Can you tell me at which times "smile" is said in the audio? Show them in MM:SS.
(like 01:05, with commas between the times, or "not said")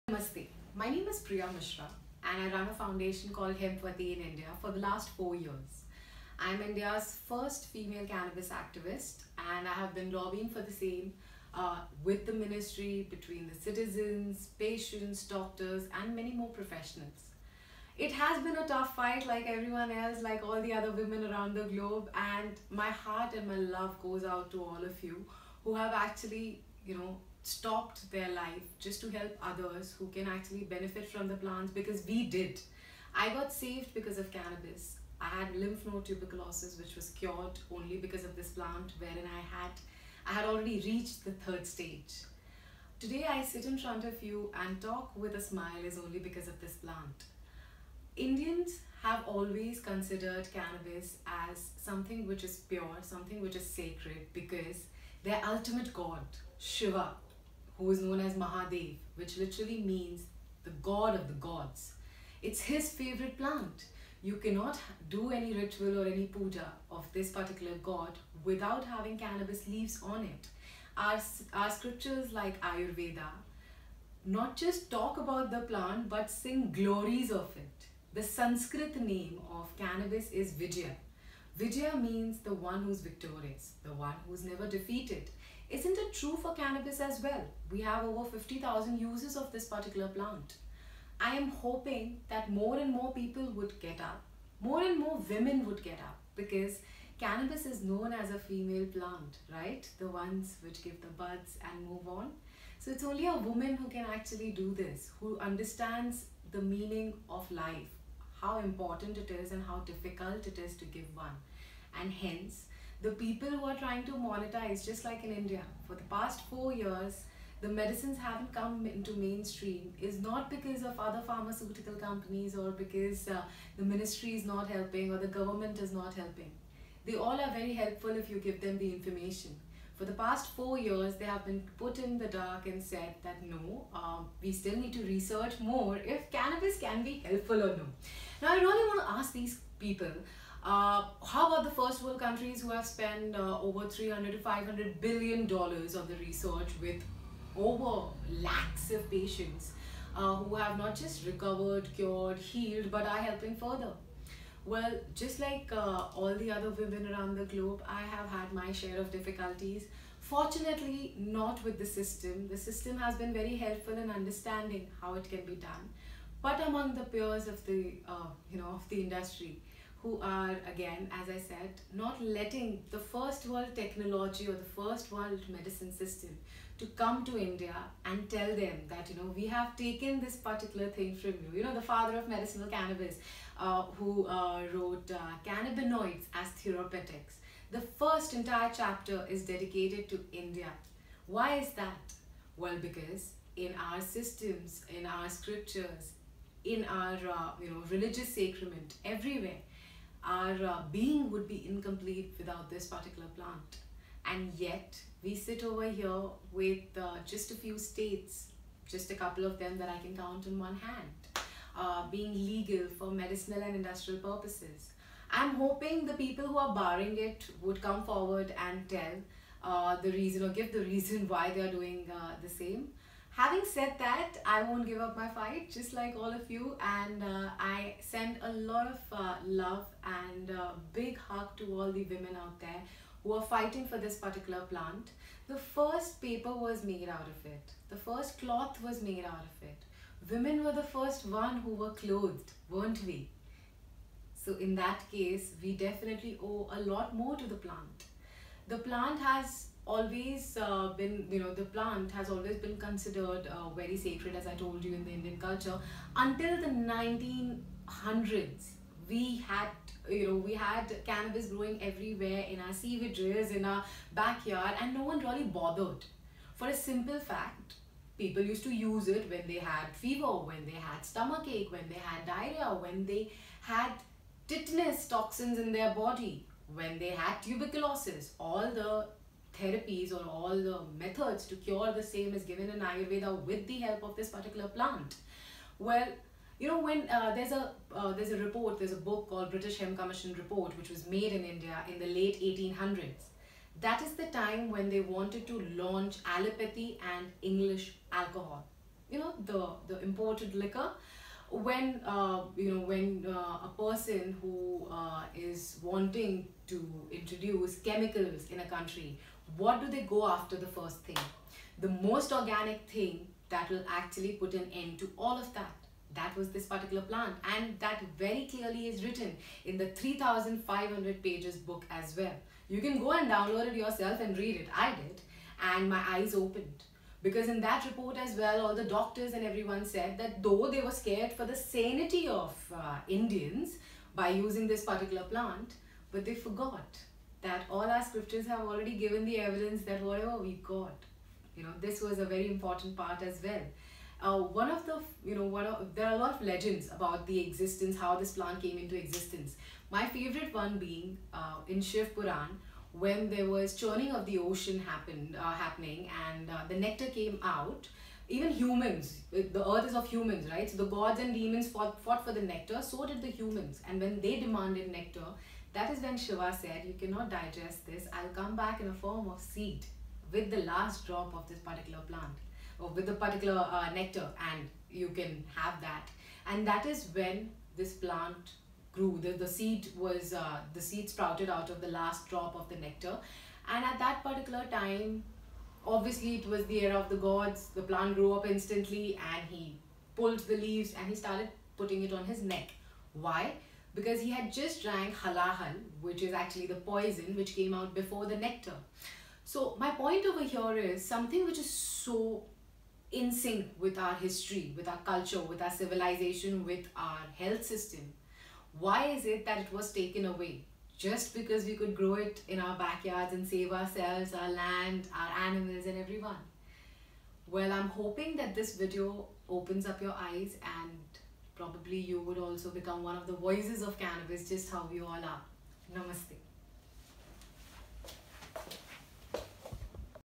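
00:45.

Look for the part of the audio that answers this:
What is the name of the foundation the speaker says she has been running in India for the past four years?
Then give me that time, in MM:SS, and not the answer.
00:03.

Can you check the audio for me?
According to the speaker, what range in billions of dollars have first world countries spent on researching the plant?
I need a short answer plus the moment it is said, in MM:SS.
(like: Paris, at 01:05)
300 to 500 billion dollars, at 02:23.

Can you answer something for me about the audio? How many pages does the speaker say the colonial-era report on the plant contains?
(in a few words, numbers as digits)
3500.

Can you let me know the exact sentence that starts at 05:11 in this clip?
The most organic thing that will actually put an end to all of that.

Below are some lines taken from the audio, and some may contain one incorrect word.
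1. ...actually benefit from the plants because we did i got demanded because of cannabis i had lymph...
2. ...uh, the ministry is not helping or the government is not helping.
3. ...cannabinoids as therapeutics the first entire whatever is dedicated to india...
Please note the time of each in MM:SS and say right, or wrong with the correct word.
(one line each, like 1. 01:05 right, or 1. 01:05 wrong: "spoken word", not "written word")
1. 00:30 wrong: "saved", not "demanded"
2. 02:03 right
3. 03:05 wrong: "chapter", not "whatever".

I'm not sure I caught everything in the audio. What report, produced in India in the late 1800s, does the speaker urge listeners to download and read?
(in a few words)
British Hemp Commission Report.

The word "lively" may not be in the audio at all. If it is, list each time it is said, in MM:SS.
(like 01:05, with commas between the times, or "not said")
not said.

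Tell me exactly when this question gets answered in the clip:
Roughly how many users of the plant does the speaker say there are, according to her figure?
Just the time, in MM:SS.
01:28.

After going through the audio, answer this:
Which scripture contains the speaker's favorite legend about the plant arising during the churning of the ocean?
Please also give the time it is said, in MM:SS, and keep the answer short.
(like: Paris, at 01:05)
Shiv Puran, at 05:51.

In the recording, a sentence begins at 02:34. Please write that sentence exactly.
Well, just like uh, all the other women around the globe, I have had my share of difficulties.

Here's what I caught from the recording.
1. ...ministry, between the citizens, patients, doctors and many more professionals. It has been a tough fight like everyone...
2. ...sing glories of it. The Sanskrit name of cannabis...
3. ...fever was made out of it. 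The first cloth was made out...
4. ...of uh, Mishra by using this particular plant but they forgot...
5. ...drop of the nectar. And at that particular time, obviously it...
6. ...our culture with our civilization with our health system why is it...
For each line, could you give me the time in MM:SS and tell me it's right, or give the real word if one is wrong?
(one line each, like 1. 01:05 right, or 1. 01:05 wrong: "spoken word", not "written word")
1. 00:12 right
2. 01:16 right
3. 03:56 wrong: "paper", not "fever"
4. 05:32 wrong: "Indians", not "Mishra"
5. 06:22 right
6. 06:44 right.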